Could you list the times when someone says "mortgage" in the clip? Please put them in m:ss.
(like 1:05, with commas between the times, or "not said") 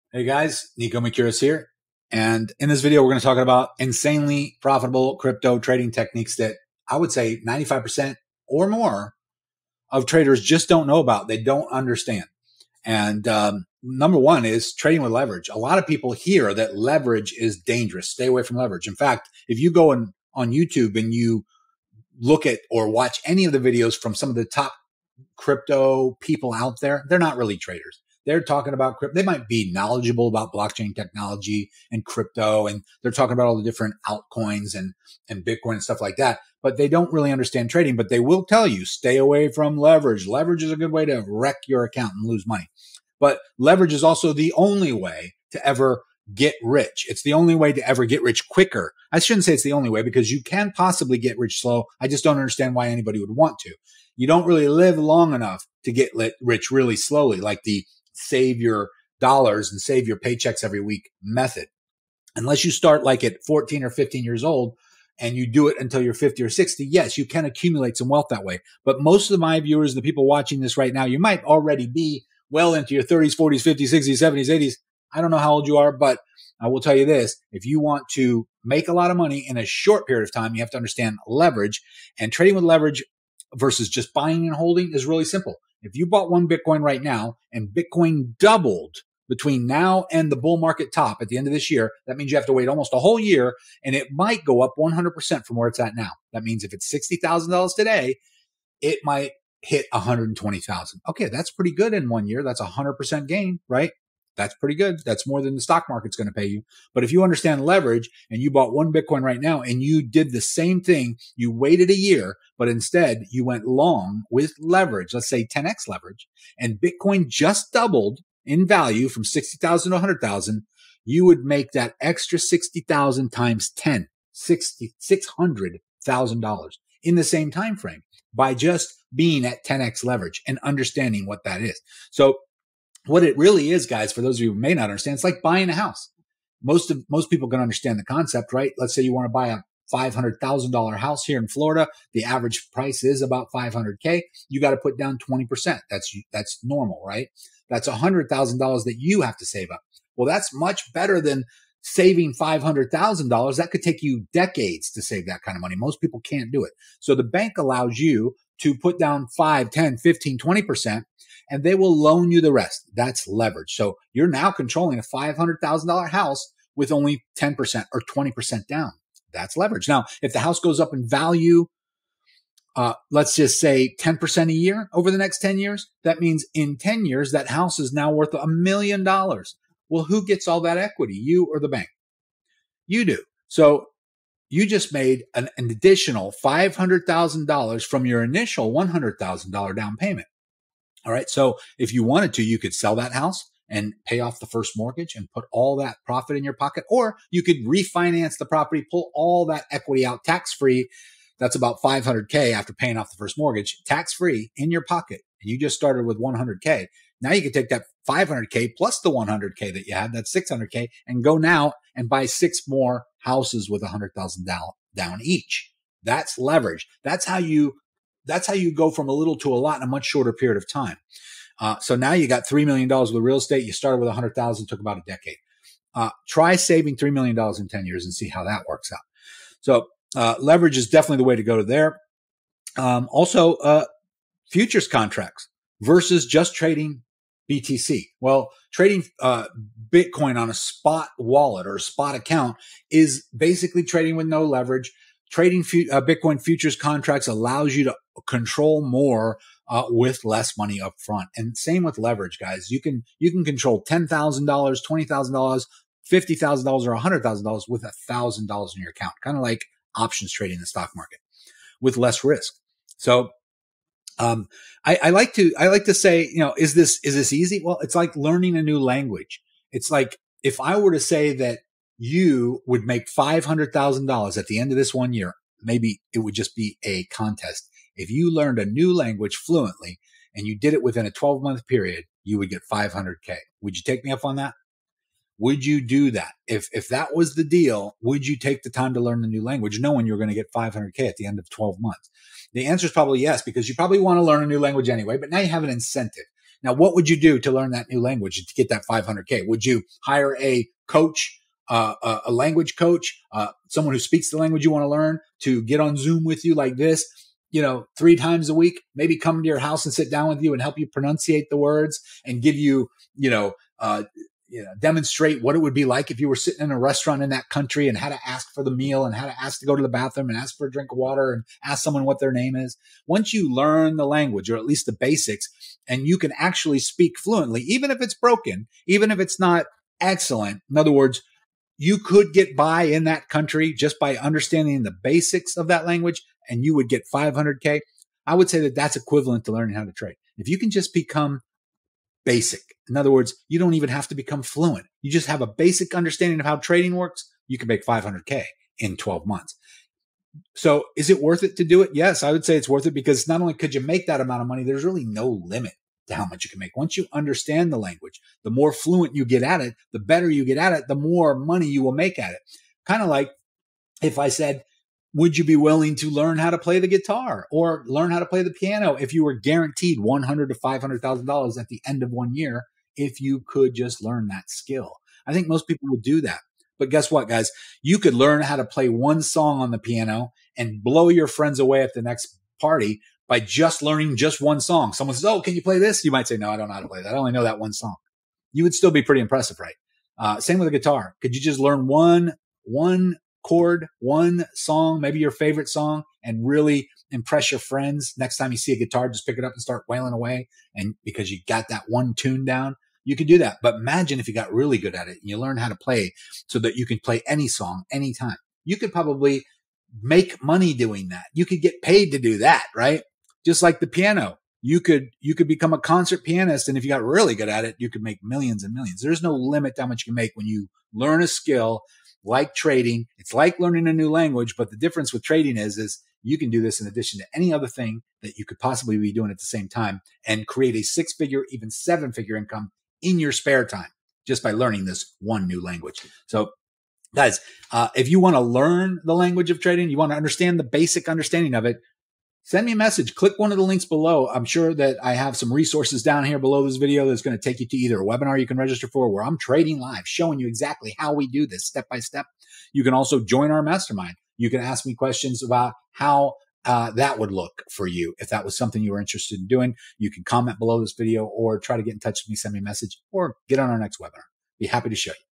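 3:14, 3:23.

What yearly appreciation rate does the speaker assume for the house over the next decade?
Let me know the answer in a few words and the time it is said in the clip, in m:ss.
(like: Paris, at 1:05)
10%, at 2:53.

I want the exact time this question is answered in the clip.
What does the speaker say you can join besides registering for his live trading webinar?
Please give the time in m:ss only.
7:33.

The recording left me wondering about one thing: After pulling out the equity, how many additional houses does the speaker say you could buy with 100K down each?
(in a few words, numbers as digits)
6.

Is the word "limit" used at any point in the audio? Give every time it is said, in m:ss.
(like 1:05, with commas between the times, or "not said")
5:55, 6:59.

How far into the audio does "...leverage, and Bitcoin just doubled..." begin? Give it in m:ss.
1:55.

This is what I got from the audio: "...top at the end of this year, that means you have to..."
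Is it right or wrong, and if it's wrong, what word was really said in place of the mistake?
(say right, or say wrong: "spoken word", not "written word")
right.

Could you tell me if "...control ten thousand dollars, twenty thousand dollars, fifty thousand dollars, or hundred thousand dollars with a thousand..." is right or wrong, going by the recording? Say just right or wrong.
right.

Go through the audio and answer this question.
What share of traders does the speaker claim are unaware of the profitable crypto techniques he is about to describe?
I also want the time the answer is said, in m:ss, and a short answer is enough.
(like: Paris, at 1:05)
95%, at 0:07.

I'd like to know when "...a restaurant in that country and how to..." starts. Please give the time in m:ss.
5:16.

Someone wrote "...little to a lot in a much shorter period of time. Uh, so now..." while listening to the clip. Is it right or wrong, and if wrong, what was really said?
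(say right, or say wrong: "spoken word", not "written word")
right.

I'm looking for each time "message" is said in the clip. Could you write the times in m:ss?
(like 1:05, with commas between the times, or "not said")
7:22, 7:42.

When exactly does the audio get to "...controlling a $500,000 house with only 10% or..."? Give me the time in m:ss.
2:44.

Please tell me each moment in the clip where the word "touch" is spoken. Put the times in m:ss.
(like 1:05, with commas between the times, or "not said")
7:41.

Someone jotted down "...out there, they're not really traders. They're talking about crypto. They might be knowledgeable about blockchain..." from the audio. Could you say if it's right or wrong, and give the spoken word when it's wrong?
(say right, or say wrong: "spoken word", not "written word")
right.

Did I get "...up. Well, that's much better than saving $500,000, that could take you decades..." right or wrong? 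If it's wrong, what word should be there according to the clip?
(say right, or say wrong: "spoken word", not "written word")
right.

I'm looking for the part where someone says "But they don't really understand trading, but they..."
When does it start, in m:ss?
0:36.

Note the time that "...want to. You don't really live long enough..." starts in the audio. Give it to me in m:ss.
0:53.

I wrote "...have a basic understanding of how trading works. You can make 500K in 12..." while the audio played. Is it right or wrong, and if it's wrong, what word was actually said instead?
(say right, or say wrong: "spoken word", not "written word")
right.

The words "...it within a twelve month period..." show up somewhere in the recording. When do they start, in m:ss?
4:40.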